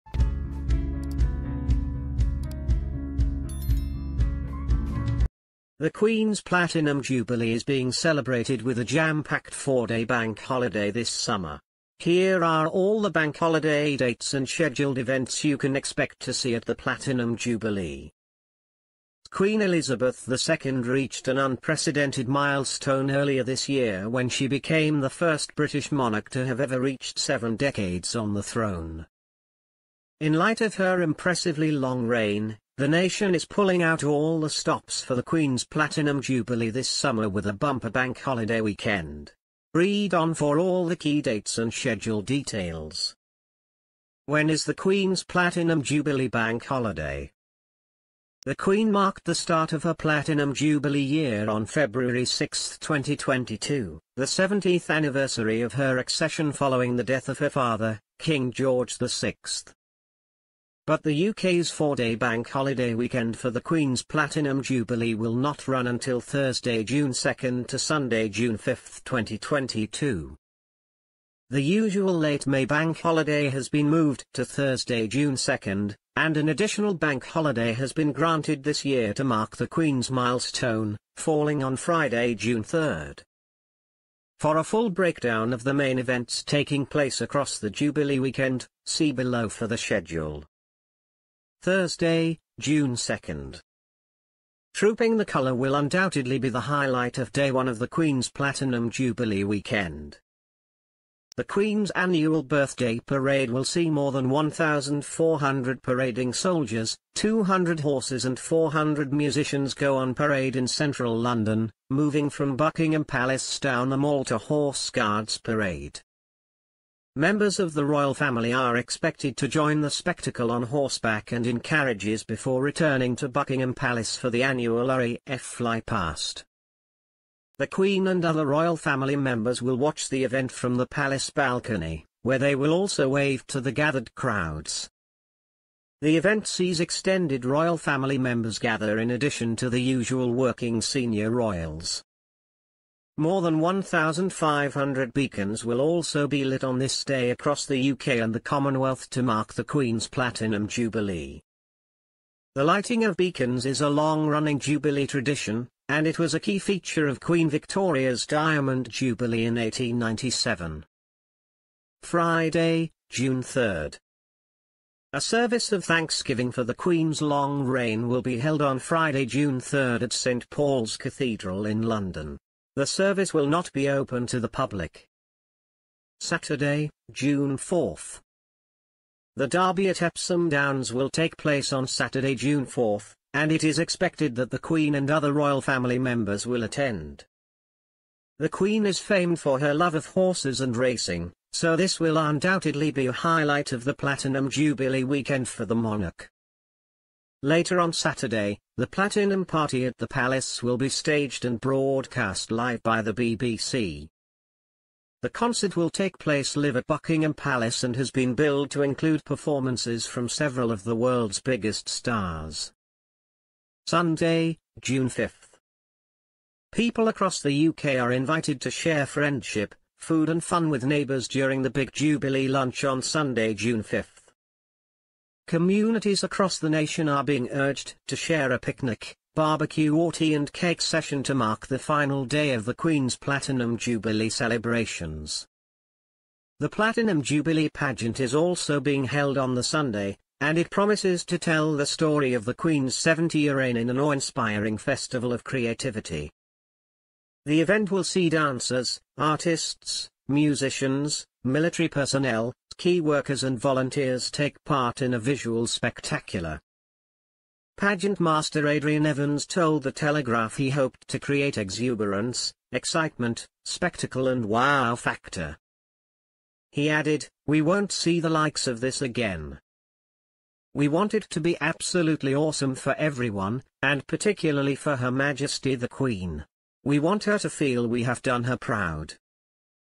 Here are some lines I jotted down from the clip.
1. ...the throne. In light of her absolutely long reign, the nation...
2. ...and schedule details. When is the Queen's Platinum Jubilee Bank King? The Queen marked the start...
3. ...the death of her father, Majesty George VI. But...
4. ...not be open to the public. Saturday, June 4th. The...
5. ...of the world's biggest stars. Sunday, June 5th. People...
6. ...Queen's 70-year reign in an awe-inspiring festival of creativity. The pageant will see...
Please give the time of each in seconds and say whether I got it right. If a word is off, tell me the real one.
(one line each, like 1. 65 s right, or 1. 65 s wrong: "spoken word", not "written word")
1. 28 s wrong: "impressively", not "absolutely"
2. 41 s wrong: "Holiday", not "King"
3. 56 s wrong: "King", not "Majesty"
4. 173 s right
5. 210 s right
6. 242 s wrong: "event", not "pageant".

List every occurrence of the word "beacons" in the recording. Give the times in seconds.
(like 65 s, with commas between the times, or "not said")
145 s, 153 s.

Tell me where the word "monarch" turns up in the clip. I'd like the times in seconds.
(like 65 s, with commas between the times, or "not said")
25 s, 195 s.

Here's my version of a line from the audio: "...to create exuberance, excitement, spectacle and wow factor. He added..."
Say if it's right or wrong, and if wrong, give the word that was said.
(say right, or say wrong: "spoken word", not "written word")
right.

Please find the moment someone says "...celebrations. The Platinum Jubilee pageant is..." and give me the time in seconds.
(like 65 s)
234 s.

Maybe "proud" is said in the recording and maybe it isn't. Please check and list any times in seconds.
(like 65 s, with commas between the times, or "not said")
278 s.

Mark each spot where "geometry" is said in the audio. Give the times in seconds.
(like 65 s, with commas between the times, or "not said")
not said.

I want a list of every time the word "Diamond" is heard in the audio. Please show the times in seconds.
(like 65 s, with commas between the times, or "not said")
158 s.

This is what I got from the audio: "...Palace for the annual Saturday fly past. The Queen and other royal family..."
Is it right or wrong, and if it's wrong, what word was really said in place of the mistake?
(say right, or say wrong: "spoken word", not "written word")
wrong: "RAF", not "Saturday".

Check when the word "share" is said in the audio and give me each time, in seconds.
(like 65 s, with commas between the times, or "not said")
218 s, 228 s.